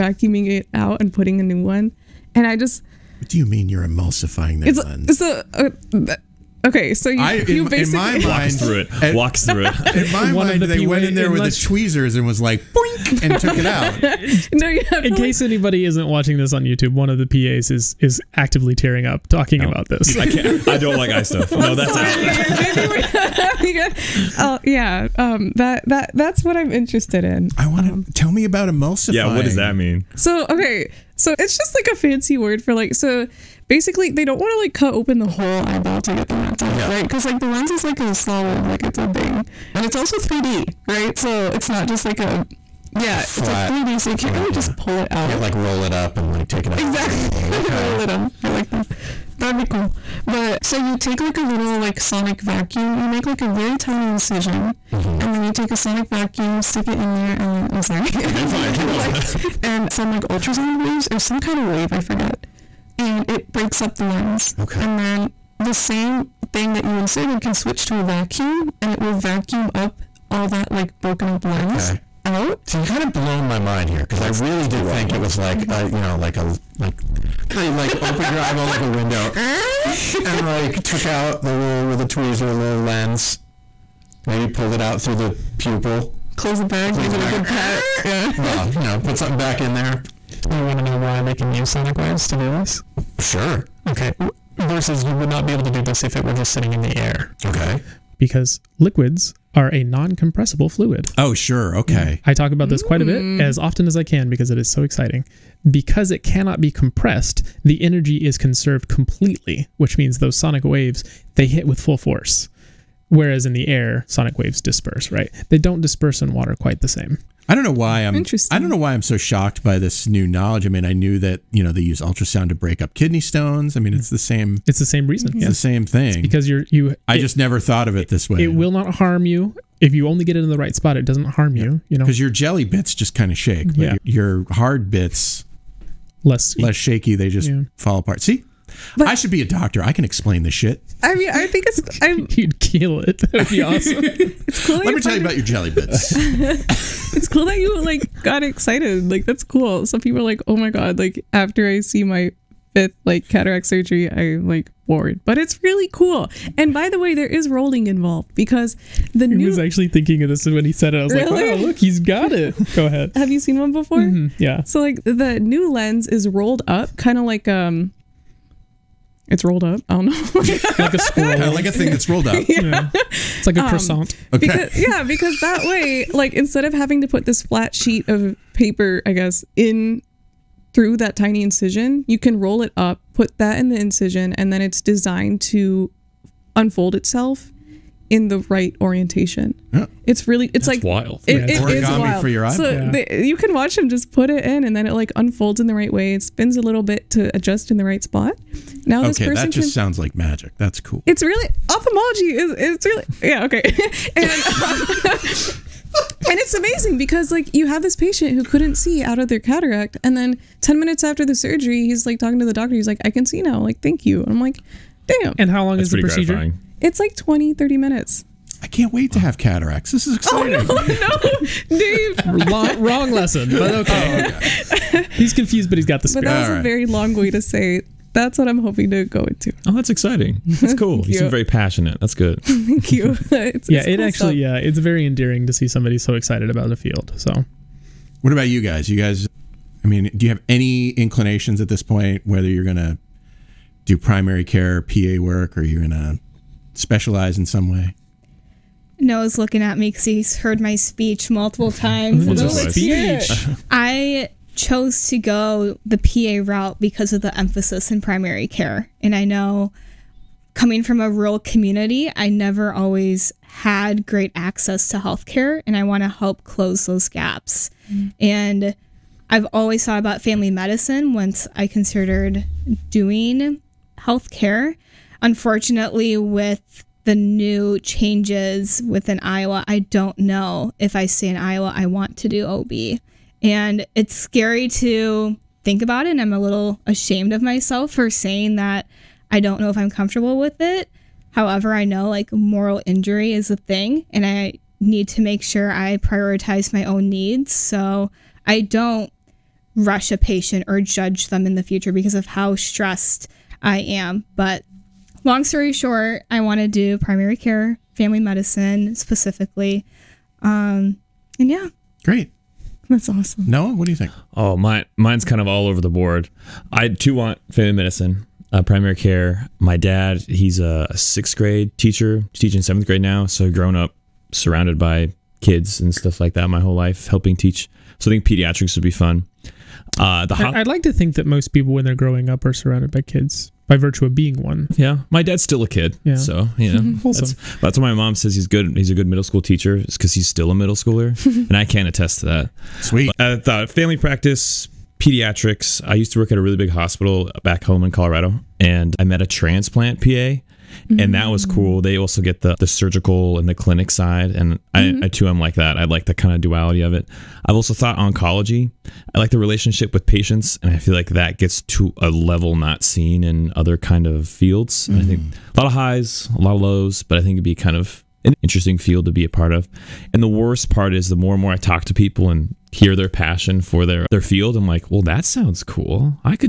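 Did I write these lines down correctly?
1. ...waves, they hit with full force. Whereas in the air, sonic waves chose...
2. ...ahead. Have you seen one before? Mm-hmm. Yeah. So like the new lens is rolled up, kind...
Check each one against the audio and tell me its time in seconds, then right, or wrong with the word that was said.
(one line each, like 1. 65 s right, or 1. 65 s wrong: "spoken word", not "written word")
1. 110 s wrong: "disperse", not "chose"
2. 162 s right.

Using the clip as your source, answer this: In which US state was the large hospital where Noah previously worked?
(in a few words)
Colorado.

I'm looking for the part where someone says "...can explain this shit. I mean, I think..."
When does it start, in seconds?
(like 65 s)
139 s.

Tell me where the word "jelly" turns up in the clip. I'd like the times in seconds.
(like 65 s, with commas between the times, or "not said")
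132 s, 145 s.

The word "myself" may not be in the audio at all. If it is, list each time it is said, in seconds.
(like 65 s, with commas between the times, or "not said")
287 s.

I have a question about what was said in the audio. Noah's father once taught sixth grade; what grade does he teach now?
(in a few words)
seventh grade.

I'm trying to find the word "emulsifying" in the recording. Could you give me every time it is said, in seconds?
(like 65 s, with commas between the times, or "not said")
3 s, 28 s.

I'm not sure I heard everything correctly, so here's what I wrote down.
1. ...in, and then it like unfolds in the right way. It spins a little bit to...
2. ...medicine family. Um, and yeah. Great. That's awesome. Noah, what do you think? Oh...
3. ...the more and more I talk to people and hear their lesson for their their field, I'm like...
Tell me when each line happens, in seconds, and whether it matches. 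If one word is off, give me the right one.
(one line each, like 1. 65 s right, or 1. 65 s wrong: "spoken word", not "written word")
1. 194 s right
2. 308 s wrong: "specifically", not "family"
3. 371 s wrong: "passion", not "lesson".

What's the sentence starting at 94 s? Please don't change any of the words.
Versus, you would not be able to do this if it were just sitting in the air.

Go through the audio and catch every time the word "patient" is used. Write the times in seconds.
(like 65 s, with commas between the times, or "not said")
207 s, 300 s, 360 s.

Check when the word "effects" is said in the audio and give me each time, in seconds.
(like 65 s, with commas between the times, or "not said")
not said.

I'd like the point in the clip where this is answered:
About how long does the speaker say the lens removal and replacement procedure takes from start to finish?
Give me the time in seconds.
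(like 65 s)
217 s.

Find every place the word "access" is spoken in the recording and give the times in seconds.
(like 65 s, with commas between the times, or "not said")
264 s.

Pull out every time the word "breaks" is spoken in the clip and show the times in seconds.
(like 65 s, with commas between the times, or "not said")
63 s, 122 s.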